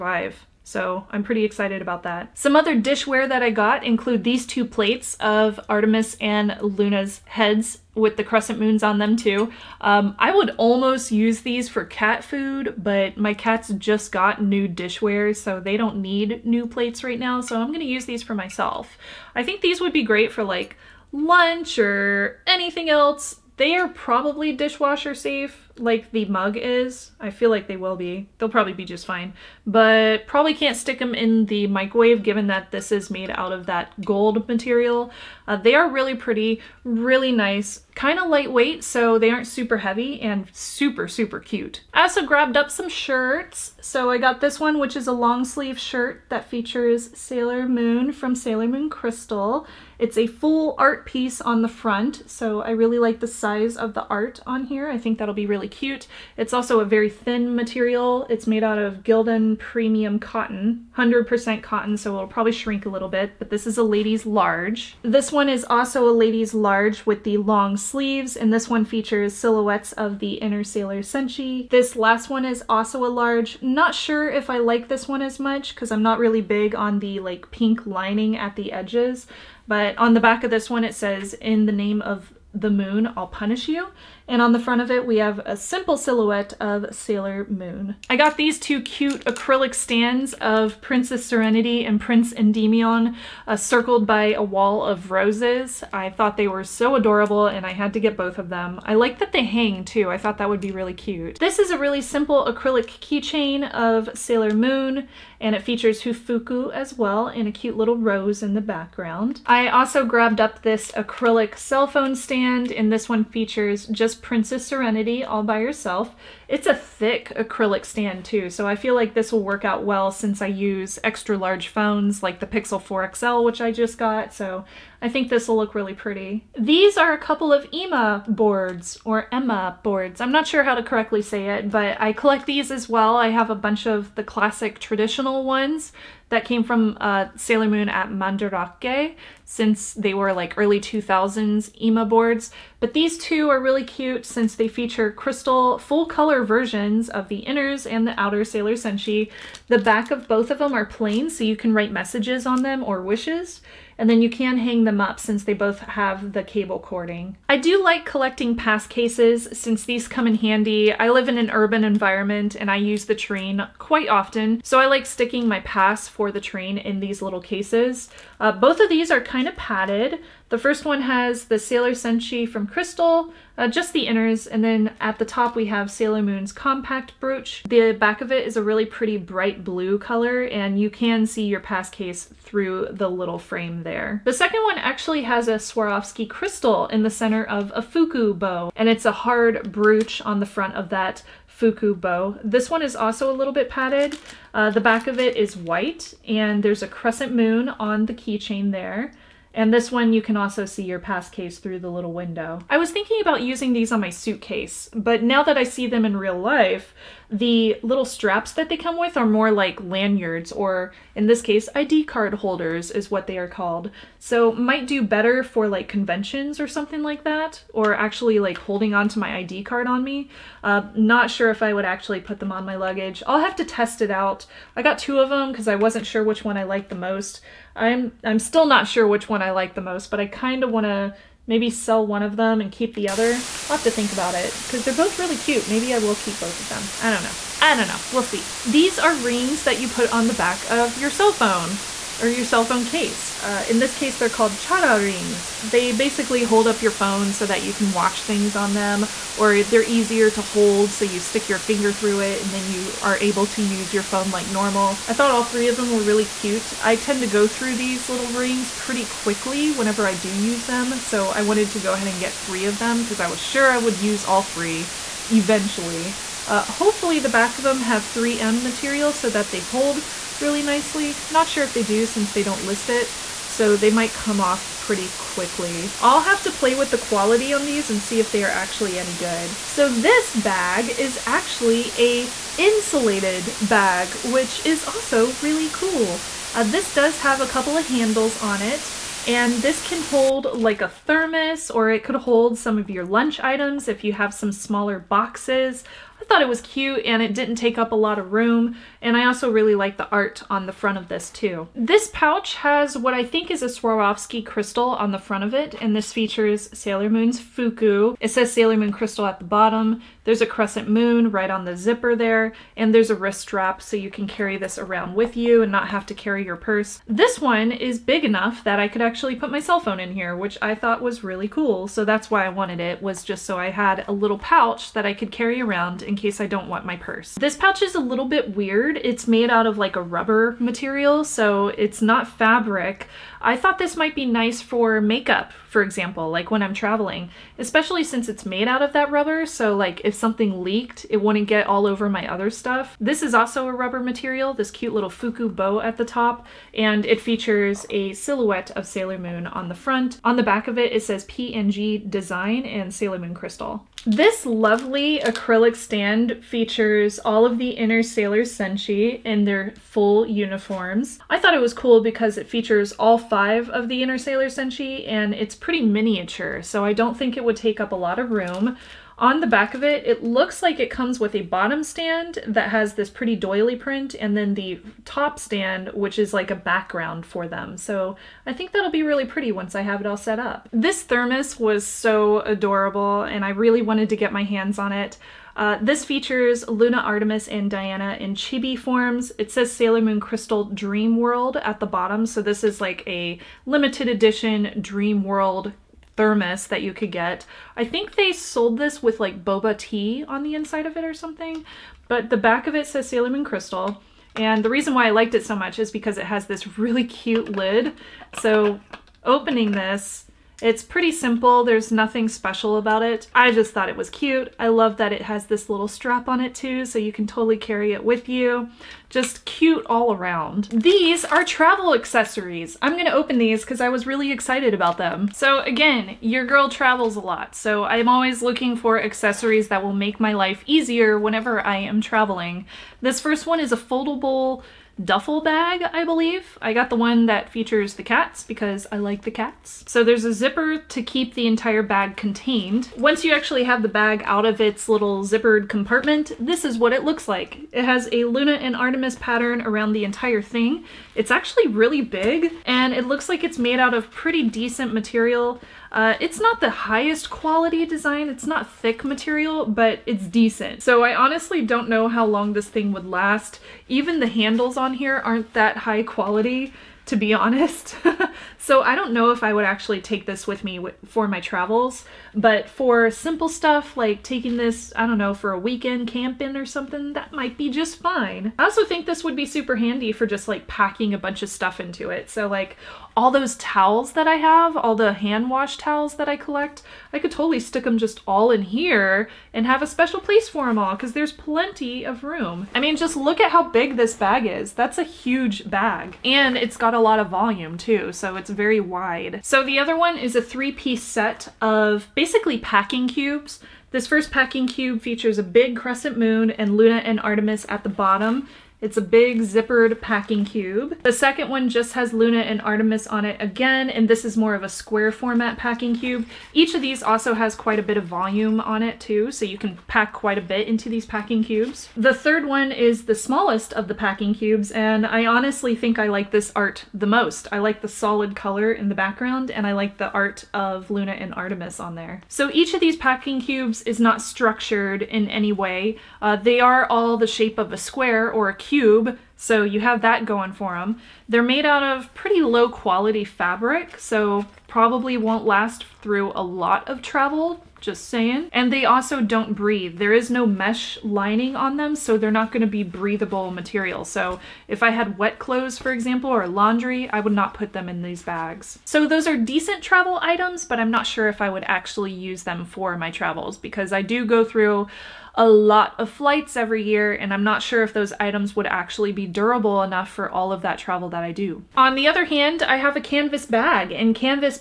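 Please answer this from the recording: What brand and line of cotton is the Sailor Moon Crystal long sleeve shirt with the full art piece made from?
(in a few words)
Gildan Premium Cotton.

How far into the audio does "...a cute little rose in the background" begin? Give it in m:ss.
1:47.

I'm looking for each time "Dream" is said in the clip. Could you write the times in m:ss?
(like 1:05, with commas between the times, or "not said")
6:30, 6:34.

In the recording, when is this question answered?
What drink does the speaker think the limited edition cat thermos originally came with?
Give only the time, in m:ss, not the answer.
6:39.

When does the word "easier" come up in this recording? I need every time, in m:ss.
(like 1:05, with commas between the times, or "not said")
4:09, 7:10.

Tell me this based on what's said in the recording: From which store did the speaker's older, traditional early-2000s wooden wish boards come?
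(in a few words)
Mandarake.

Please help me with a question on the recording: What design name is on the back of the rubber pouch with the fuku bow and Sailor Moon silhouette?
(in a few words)
PNG Design.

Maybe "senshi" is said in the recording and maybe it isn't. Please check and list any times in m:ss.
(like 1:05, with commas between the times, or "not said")
1:11, 2:28, 2:51, 5:58, 6:04.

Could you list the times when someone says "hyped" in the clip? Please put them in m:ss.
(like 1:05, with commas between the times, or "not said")
not said.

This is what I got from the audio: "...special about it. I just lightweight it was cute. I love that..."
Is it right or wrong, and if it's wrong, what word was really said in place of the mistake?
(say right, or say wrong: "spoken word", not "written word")
wrong: "thought", not "lightweight".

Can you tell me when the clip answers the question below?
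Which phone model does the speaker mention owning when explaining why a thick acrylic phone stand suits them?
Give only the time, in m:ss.
2:02.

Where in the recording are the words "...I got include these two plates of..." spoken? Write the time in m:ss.
0:03.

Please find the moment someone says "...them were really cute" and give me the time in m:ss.
4:15.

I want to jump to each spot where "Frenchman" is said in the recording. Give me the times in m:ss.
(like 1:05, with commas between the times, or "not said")
not said.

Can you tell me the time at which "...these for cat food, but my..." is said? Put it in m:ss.
0:11.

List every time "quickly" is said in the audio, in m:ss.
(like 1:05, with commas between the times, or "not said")
4:19, 4:35.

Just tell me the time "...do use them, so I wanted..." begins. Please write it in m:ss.
4:20.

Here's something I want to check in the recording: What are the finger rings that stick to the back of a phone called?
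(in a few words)
chara rings.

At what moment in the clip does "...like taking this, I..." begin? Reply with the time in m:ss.
7:53.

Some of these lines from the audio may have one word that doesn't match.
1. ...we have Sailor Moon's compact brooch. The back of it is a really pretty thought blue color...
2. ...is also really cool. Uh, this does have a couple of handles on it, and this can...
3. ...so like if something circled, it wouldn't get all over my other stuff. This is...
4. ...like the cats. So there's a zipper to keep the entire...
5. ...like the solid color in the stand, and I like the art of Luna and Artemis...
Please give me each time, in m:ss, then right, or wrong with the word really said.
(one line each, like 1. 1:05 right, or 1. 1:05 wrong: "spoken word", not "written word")
1. 2:55 wrong: "bright", not "thought"
2. 4:44 right
3. 5:39 wrong: "leaked", not "circled"
4. 7:18 right
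5. 8:47 wrong: "background", not "stand".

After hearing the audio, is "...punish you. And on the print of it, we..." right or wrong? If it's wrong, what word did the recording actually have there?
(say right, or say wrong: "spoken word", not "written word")
wrong: "front", not "print".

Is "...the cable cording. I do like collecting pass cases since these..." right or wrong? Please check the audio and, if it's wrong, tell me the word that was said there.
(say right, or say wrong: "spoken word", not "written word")
right.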